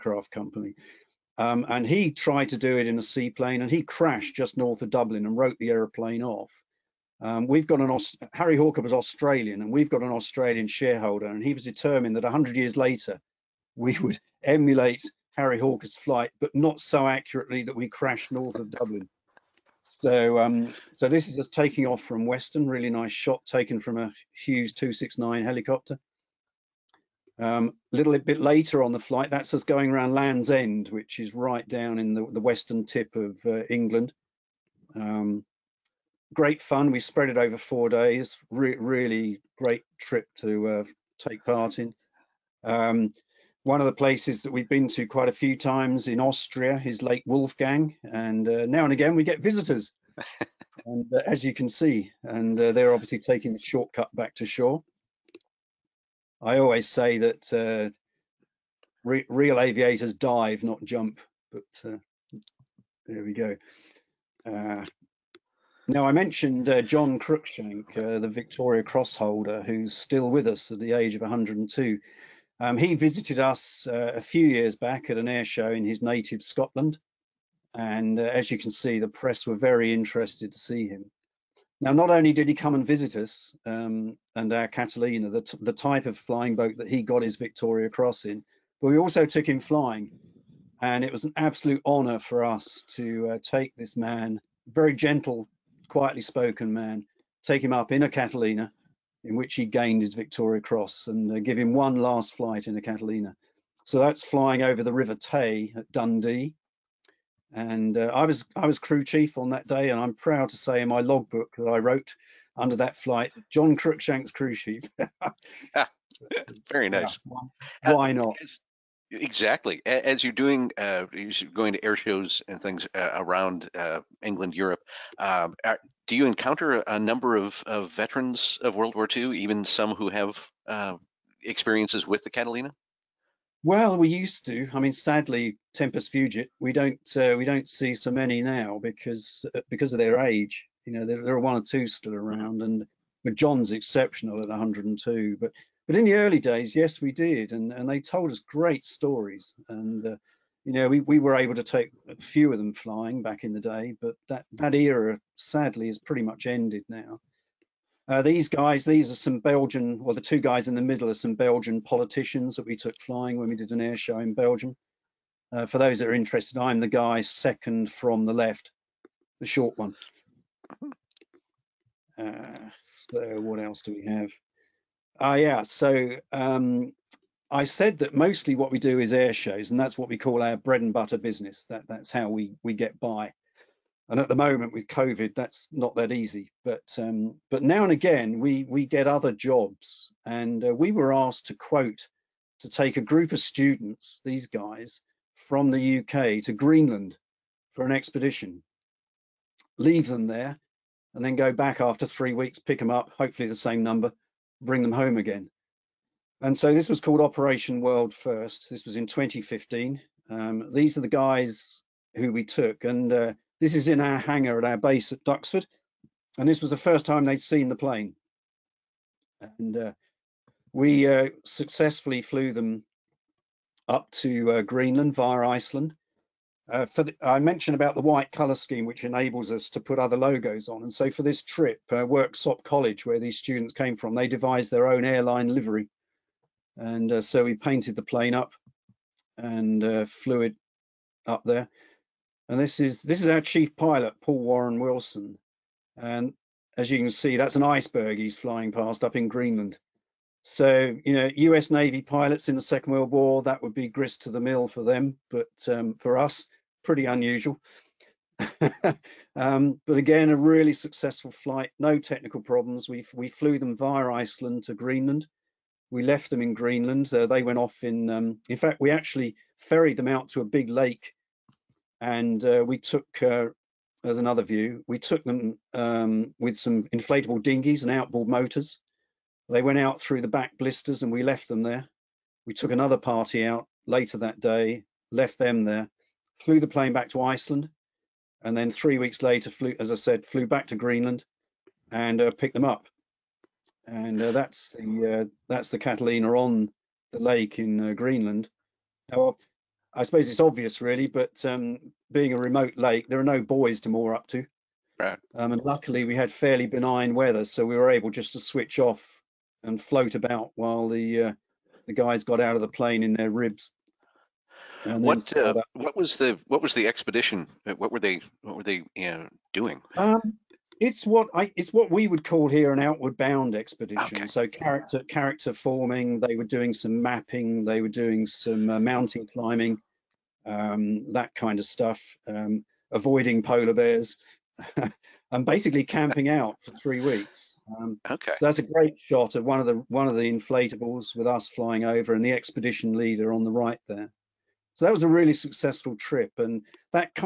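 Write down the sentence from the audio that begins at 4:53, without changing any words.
And uh, that's the uh, that's the Catalina on the lake in uh, Greenland.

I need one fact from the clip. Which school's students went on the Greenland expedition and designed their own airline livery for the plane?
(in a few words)
Worksop College.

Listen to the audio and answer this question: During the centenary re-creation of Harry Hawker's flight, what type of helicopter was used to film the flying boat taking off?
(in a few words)
Hughes 269.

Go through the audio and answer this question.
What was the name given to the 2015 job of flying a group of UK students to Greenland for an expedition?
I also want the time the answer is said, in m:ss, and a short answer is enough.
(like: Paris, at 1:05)
Operation World First, at 3:27.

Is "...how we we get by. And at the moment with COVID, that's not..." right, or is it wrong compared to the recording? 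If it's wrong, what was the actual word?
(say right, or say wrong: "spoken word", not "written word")
right.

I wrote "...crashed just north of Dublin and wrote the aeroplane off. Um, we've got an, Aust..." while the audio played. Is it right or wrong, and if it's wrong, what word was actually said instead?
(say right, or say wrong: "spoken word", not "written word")
right.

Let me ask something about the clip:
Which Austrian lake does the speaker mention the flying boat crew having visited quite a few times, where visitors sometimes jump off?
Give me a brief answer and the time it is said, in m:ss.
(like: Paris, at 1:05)
Lake Wolfgang, at 0:47.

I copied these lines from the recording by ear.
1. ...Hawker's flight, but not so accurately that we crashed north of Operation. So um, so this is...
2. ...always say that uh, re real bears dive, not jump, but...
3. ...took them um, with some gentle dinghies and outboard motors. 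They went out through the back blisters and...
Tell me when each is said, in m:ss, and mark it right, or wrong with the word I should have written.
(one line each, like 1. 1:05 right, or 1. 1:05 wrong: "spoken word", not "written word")
1. 0:15 wrong: "Dublin", not "Operation"
2. 0:56 wrong: "aviators", not "bears"
3. 4:34 wrong: "inflatable", not "gentle".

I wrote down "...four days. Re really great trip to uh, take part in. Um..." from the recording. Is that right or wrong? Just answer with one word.
right.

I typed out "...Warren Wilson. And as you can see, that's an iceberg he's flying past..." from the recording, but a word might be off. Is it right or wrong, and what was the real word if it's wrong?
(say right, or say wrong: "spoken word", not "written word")
right.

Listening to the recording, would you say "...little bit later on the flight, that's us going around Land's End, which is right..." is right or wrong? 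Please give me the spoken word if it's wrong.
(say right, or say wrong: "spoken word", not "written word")
right.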